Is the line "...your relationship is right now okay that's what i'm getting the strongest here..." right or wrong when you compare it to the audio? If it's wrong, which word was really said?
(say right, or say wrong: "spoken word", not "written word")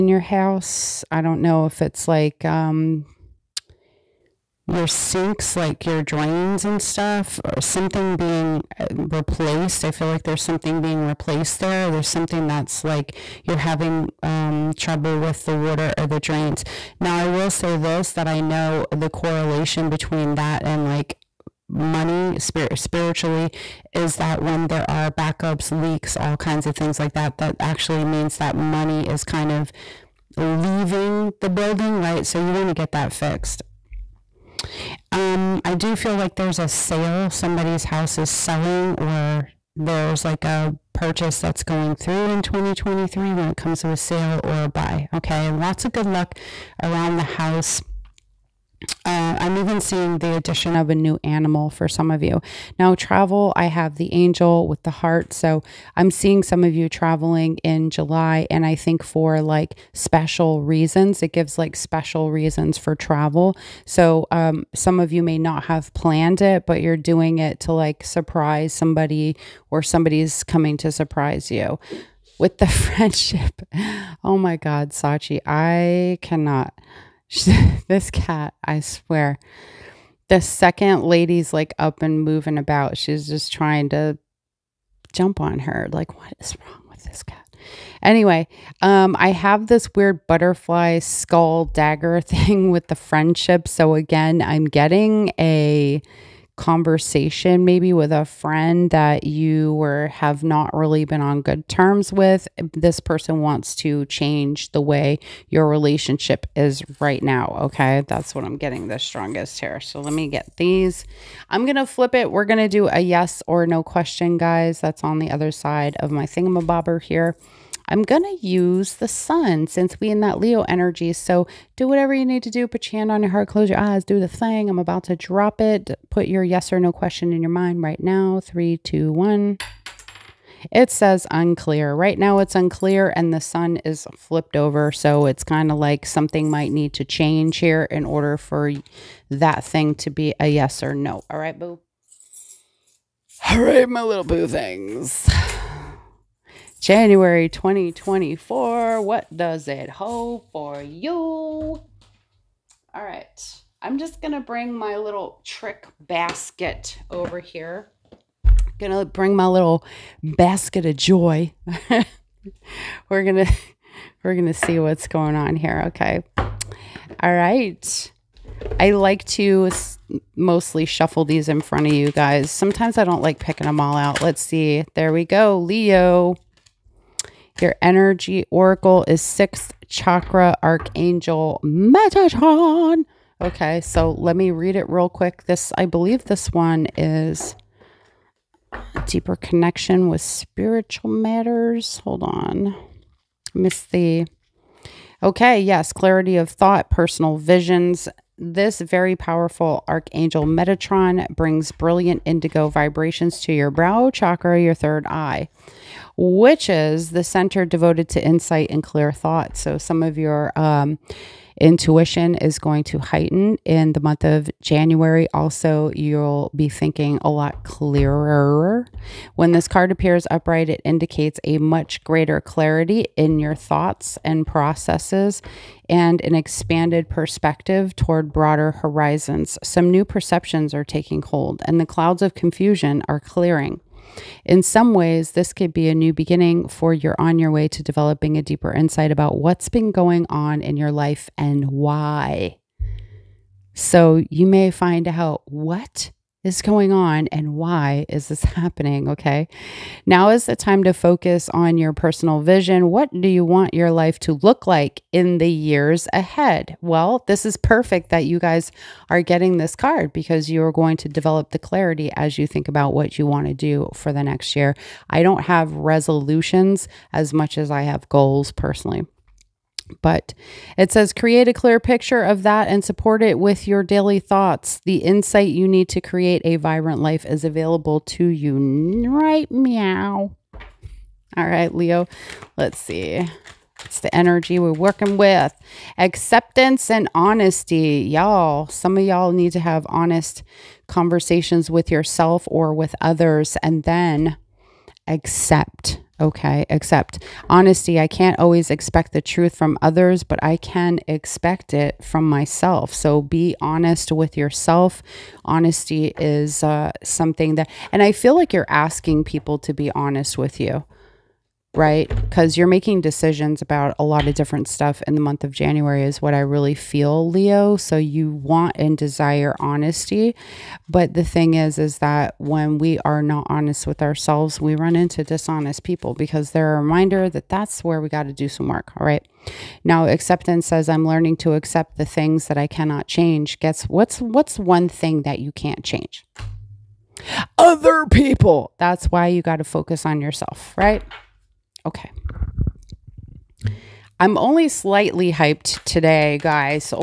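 right.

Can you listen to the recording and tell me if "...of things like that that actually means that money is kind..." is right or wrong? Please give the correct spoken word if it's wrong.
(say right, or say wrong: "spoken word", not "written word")
right.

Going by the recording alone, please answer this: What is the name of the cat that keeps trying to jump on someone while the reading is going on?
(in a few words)
Sachi.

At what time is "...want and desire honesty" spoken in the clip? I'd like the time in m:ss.
5:18.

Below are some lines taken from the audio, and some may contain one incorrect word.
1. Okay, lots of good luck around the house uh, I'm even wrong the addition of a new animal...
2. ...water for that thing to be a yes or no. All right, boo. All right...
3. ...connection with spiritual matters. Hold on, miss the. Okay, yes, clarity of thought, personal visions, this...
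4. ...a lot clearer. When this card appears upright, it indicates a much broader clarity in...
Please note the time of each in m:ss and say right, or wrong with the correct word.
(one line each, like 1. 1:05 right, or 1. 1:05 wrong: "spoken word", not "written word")
1. 0:45 wrong: "seeing", not "wrong"
2. 2:18 wrong: "order", not "water"
3. 3:09 right
4. 3:37 wrong: "greater", not "broader".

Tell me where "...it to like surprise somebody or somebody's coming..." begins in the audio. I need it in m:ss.
1:07.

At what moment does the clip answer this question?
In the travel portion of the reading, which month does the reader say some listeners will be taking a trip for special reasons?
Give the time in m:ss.
0:57.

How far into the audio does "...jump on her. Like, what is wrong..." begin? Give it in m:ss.
1:25.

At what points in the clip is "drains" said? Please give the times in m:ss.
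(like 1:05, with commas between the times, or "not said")
0:06, 0:16.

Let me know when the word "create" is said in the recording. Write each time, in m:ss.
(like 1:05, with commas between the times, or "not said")
4:31, 4:36.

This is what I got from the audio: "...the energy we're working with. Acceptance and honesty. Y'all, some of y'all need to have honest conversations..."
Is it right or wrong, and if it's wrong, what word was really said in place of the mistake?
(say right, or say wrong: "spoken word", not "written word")
right.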